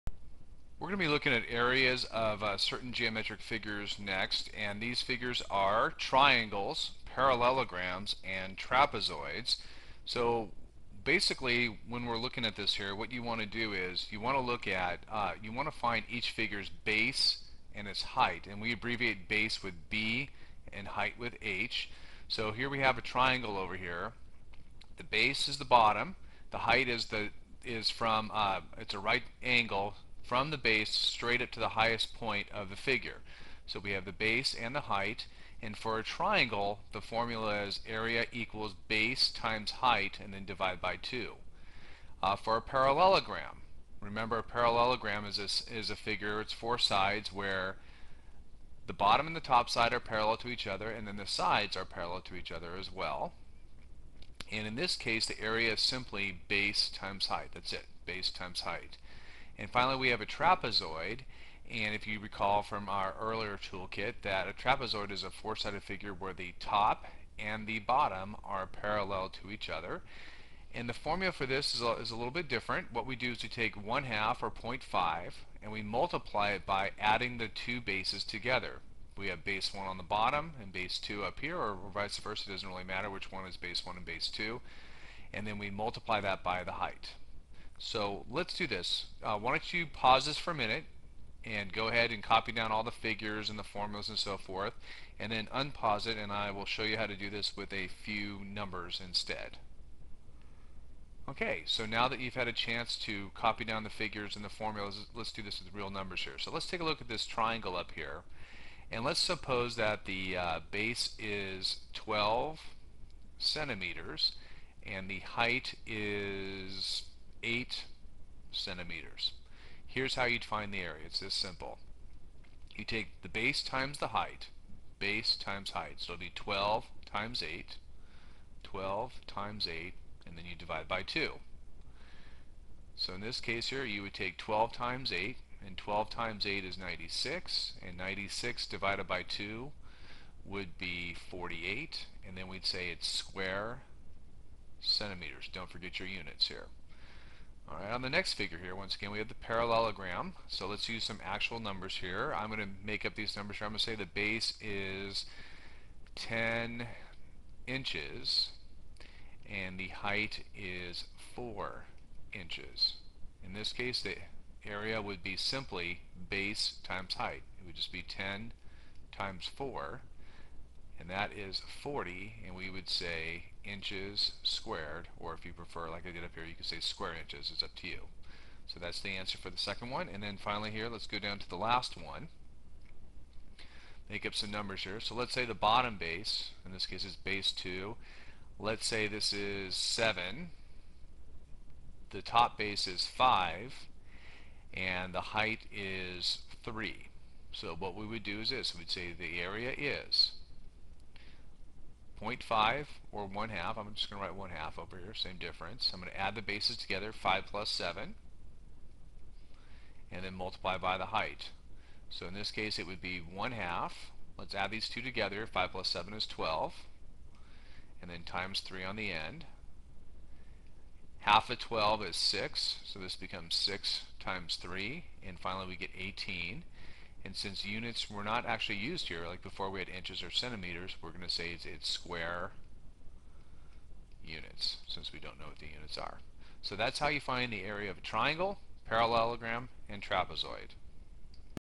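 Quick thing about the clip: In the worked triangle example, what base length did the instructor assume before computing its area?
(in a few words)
12 centimeters.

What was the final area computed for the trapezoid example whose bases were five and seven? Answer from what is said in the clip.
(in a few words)
18.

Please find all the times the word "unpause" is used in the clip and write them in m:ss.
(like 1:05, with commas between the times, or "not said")
1:35.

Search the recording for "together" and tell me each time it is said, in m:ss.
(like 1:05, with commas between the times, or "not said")
1:18, 3:26, 3:35.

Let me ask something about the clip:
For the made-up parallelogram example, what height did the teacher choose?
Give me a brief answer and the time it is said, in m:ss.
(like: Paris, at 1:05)
4 inches, at 2:41.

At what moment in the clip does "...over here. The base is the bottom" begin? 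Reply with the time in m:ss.
0:23.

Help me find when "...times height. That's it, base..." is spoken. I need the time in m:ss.
0:56.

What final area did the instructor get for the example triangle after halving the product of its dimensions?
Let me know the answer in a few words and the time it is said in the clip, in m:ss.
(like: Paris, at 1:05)
48, at 2:21.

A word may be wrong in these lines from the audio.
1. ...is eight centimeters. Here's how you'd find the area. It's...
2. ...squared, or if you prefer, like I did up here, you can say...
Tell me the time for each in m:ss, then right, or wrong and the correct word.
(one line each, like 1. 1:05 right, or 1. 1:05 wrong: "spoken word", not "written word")
1. 1:55 right
2. 2:54 right.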